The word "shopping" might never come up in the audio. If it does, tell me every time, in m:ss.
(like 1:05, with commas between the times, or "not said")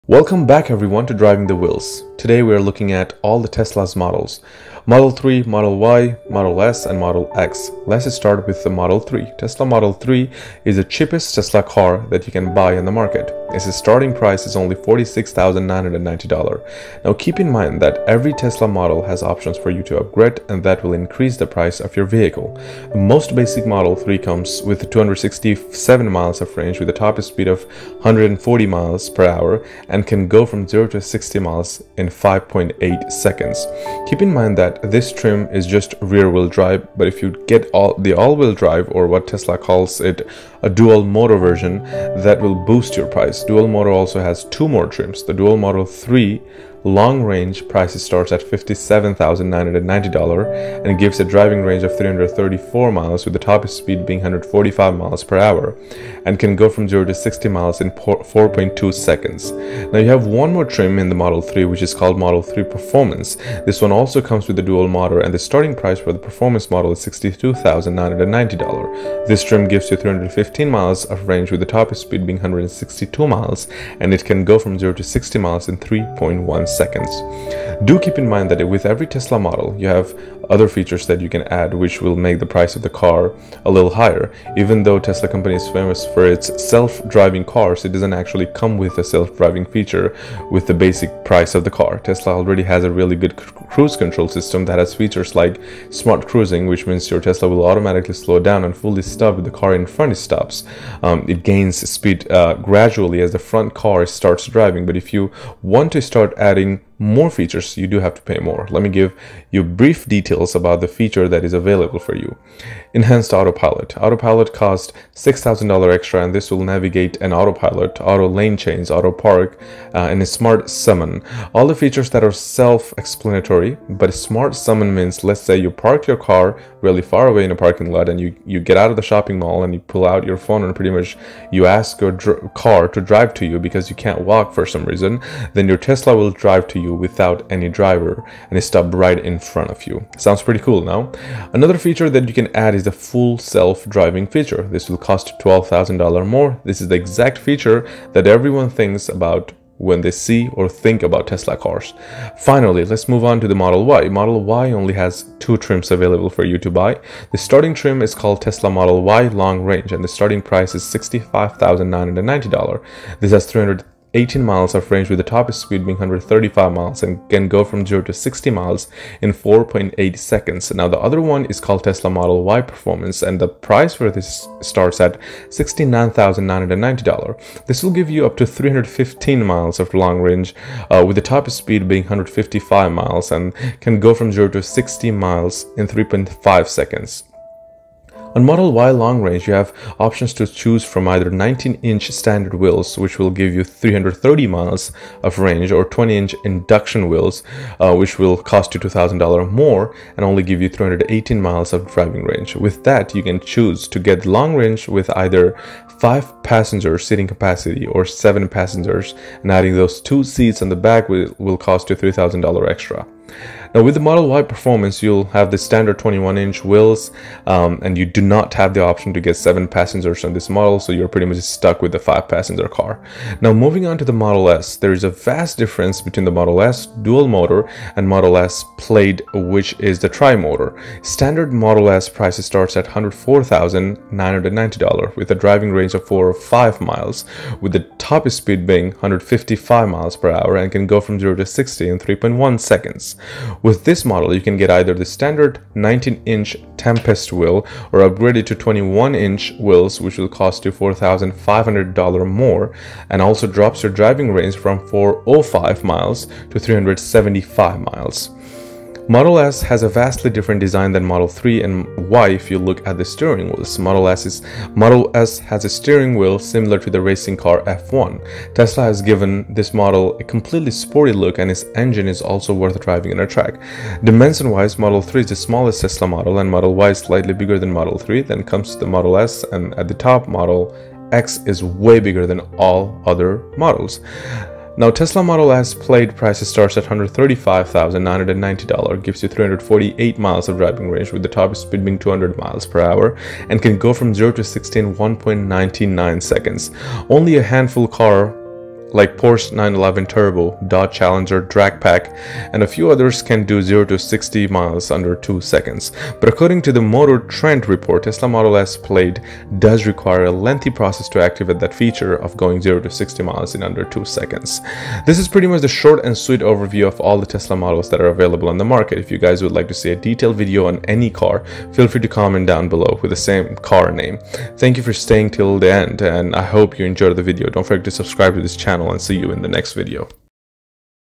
2:09.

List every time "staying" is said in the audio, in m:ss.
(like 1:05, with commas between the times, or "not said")
5:24.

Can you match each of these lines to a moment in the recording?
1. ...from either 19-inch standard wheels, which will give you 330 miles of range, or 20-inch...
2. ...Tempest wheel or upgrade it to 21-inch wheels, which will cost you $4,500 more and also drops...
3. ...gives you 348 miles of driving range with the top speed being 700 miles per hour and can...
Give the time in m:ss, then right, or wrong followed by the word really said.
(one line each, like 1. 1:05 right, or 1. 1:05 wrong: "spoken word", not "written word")
1. 3:10 right
2. 4:06 right
3. 4:49 wrong: "200", not "700".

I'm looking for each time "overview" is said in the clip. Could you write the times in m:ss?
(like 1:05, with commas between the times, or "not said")
5:16.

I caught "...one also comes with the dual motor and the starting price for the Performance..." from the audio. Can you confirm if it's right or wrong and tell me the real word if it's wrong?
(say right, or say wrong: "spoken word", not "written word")
right.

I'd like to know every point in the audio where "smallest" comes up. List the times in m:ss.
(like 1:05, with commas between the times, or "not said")
4:35.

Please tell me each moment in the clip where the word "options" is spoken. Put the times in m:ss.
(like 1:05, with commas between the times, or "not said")
0:19, 3:09, 3:38.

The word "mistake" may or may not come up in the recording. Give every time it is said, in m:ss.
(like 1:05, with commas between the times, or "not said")
not said.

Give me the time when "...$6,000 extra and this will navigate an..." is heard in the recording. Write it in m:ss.
1:55.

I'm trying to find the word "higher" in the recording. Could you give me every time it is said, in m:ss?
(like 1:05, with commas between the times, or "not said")
1:23.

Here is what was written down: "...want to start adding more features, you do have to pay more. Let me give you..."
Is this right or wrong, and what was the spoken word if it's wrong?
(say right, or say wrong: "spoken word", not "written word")
right.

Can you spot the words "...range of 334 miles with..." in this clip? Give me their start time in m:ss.
0:51.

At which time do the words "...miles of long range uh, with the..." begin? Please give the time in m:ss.
2:59.